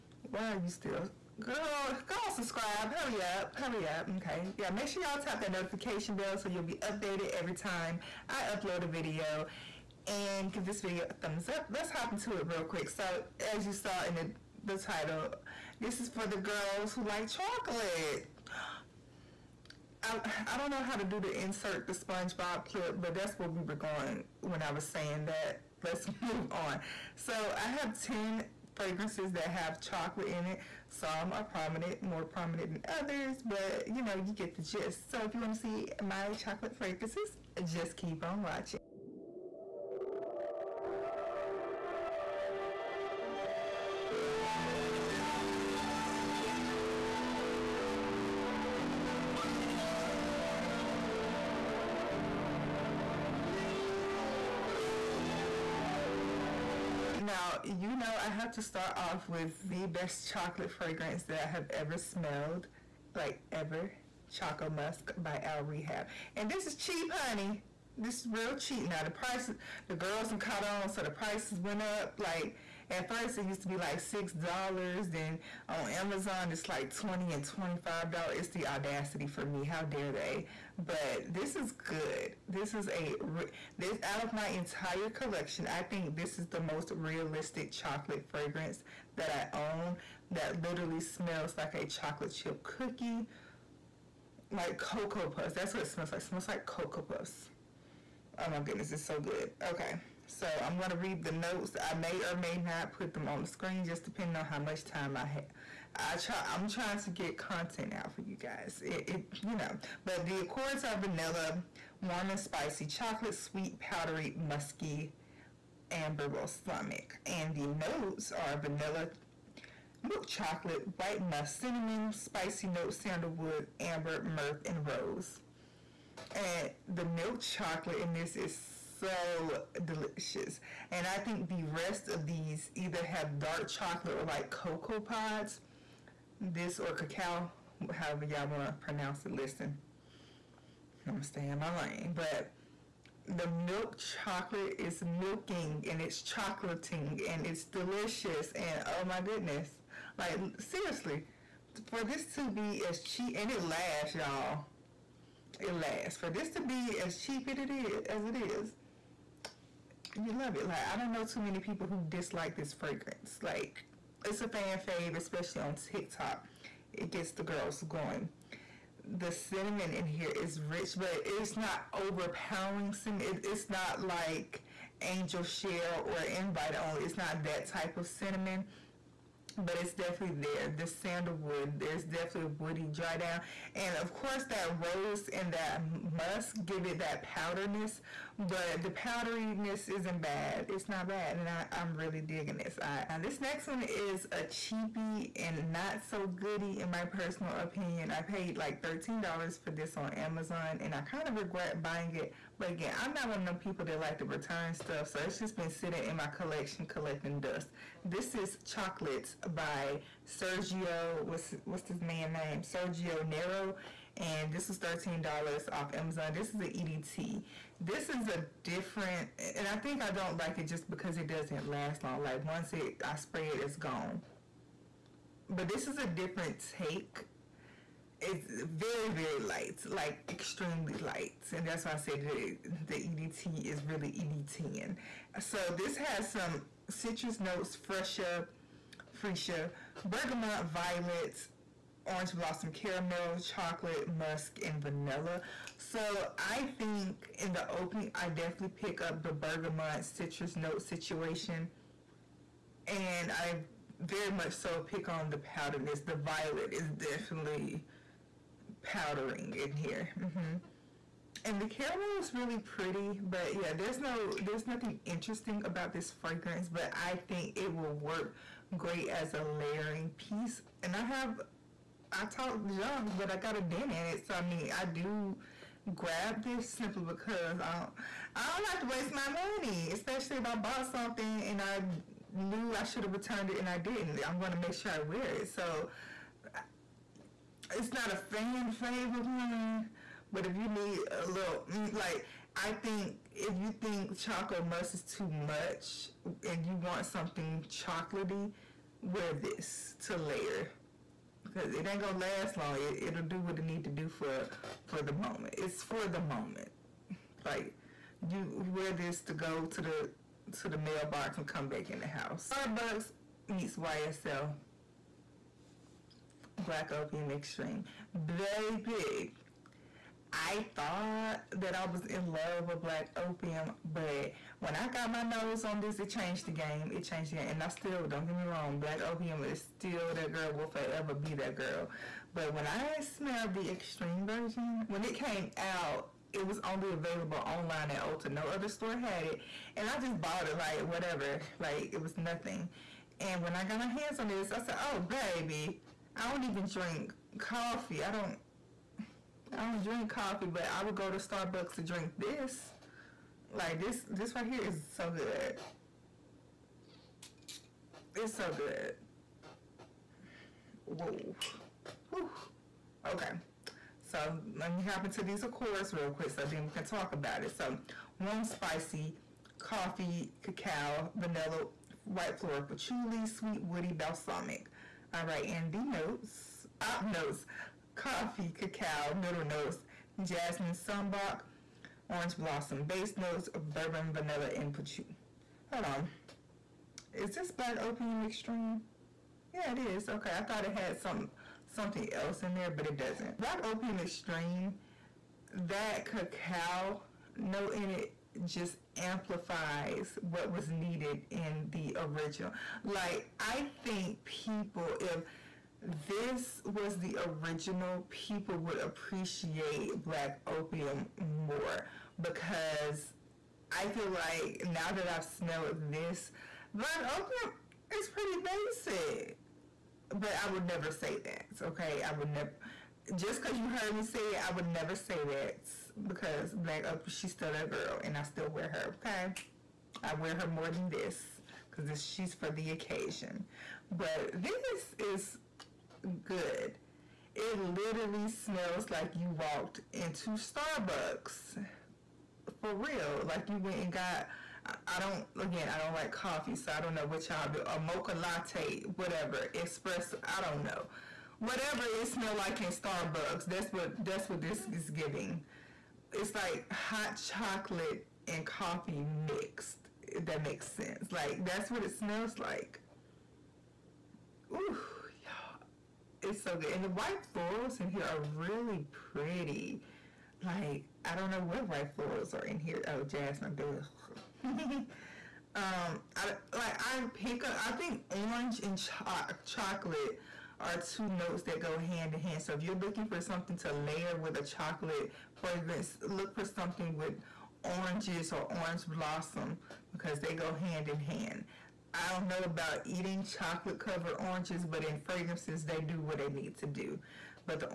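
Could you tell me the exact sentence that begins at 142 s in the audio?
But the milk chocolate is milking and it's chocolating and it's delicious.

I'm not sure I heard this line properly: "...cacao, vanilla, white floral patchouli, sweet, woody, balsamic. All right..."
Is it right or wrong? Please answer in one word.
right.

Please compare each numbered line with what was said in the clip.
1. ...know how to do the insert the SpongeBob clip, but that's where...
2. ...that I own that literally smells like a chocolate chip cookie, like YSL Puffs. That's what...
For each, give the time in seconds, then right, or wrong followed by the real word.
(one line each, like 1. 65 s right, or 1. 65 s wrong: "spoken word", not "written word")
1. 20 s right
2. 89 s wrong: "Cocoa", not "YSL".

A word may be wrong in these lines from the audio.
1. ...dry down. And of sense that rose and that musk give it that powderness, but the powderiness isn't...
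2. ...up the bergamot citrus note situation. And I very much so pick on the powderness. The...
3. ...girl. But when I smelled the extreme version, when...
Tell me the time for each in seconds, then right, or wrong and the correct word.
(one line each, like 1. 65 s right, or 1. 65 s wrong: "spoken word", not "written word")
1. 182 s wrong: "course", not "sense"
2. 249 s right
3. 331 s right.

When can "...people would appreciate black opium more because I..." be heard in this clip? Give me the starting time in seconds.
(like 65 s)
408 s.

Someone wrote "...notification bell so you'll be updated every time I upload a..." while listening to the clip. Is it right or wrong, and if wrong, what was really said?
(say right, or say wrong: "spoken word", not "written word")
right.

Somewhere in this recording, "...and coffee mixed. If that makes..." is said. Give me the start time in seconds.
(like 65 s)
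458 s.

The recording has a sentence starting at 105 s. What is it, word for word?
I try, I'm trying to get content out for you guys.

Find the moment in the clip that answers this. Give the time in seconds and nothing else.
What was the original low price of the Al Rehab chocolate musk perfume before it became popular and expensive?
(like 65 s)
74 s.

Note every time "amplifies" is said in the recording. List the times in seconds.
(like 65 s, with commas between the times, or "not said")
399 s.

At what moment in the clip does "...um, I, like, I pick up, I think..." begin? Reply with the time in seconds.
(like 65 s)
475 s.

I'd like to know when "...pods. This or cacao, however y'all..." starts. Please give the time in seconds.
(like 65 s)
134 s.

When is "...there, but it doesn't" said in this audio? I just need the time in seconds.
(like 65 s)
392 s.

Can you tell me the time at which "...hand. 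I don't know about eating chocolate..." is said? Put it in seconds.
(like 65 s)
491 s.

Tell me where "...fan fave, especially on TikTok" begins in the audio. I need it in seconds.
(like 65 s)
164 s.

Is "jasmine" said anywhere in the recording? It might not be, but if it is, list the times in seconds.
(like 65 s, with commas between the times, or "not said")
380 s, 473 s.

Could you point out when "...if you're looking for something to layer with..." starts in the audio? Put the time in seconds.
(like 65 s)
482 s.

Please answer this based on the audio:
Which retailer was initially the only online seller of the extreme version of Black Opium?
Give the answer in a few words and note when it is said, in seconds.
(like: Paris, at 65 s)
Ulta, at 338 s.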